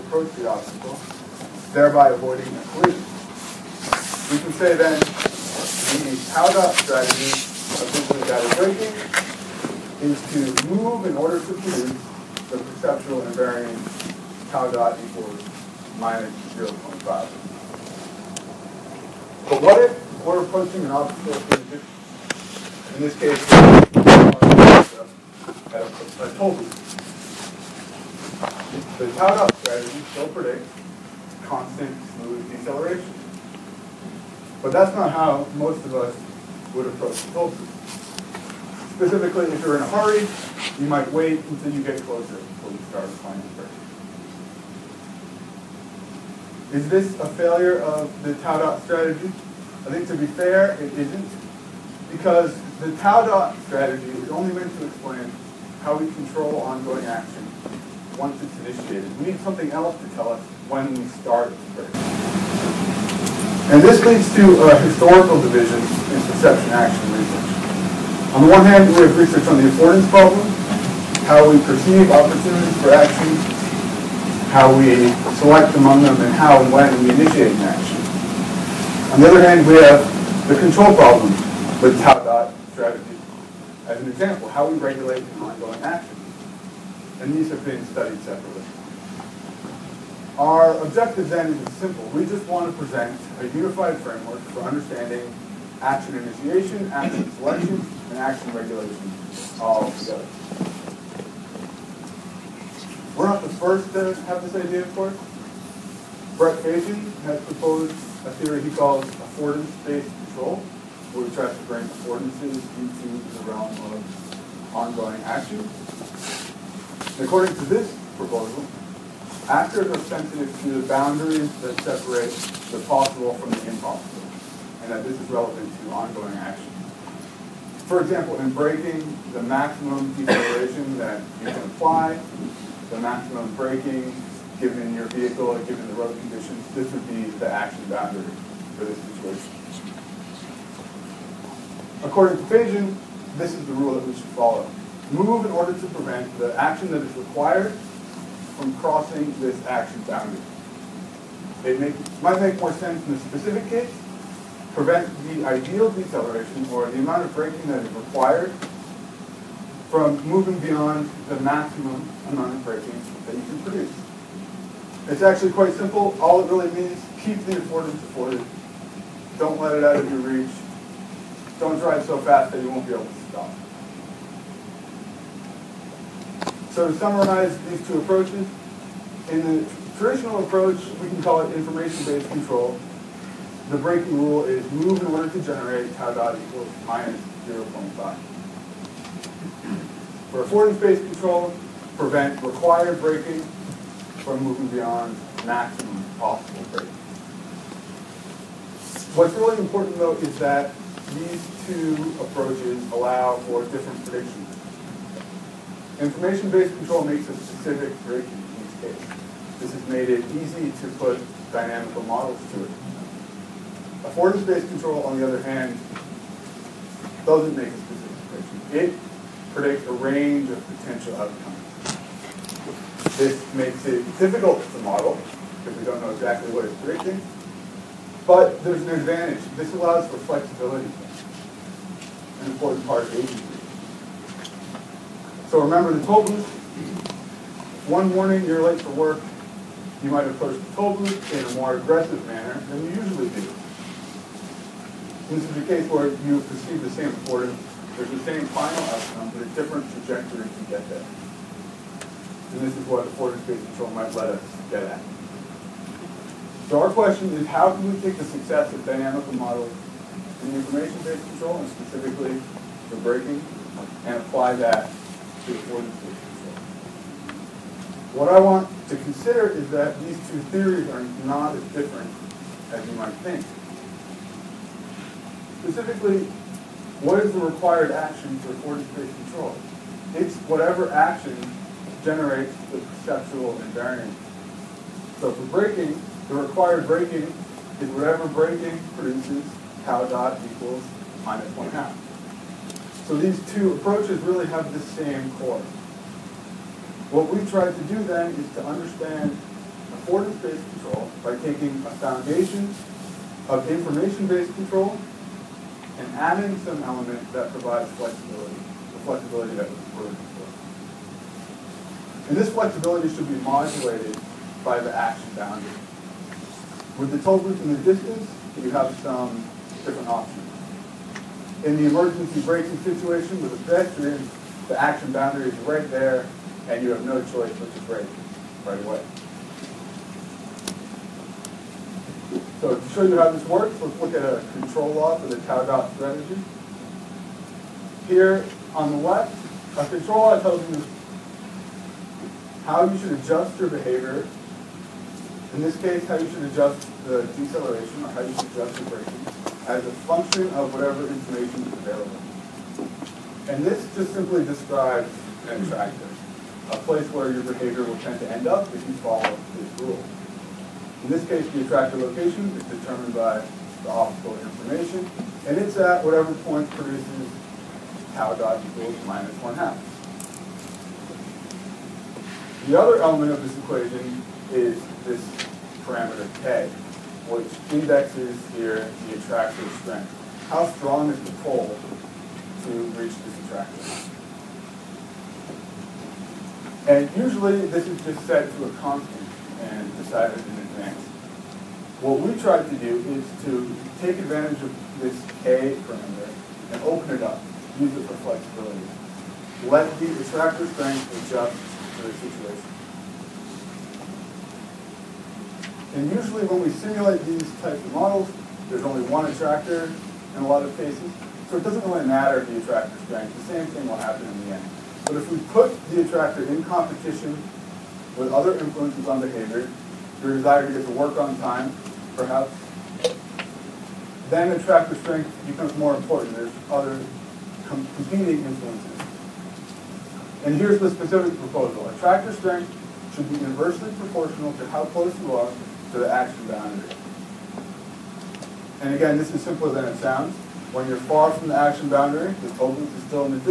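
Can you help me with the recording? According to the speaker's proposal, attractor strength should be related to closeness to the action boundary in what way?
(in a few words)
inversely proportional.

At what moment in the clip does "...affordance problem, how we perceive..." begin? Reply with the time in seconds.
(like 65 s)
69 s.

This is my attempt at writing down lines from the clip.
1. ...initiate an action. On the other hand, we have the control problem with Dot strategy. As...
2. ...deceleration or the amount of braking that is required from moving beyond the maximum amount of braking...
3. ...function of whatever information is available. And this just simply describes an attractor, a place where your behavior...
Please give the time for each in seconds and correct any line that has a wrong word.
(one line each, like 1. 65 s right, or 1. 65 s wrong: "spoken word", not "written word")
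1. 77 s right
2. 155 s right
3. 350 s right.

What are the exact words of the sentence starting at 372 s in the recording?
The other element of this equation is this parameter k, which indexes here the attractor strength.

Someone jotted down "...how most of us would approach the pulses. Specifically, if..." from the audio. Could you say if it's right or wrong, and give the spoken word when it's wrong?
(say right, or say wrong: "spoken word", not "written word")
right.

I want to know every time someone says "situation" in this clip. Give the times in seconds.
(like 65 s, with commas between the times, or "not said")
138 s, 322 s, 402 s.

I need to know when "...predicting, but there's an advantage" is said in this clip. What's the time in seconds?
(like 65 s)
226 s.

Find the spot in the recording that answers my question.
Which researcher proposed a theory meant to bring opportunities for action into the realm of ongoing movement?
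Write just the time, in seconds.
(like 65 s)
106 s.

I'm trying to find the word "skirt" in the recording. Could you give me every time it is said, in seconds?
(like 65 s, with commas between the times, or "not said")
not said.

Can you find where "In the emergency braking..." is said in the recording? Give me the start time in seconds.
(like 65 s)
321 s.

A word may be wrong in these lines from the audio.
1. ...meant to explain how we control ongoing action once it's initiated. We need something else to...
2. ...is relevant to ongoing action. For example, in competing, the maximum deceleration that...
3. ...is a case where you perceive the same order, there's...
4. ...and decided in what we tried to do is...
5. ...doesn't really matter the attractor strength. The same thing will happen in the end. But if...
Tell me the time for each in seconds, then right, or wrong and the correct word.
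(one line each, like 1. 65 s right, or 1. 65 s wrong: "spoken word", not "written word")
1. 54 s right
2. 125 s wrong: "braking", not "competing"
3. 245 s right
4. 389 s right
5. 411 s right.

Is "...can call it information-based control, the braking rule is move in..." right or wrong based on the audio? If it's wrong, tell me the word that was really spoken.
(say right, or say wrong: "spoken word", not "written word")
right.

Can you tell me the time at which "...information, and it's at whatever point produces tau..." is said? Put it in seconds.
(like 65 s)
364 s.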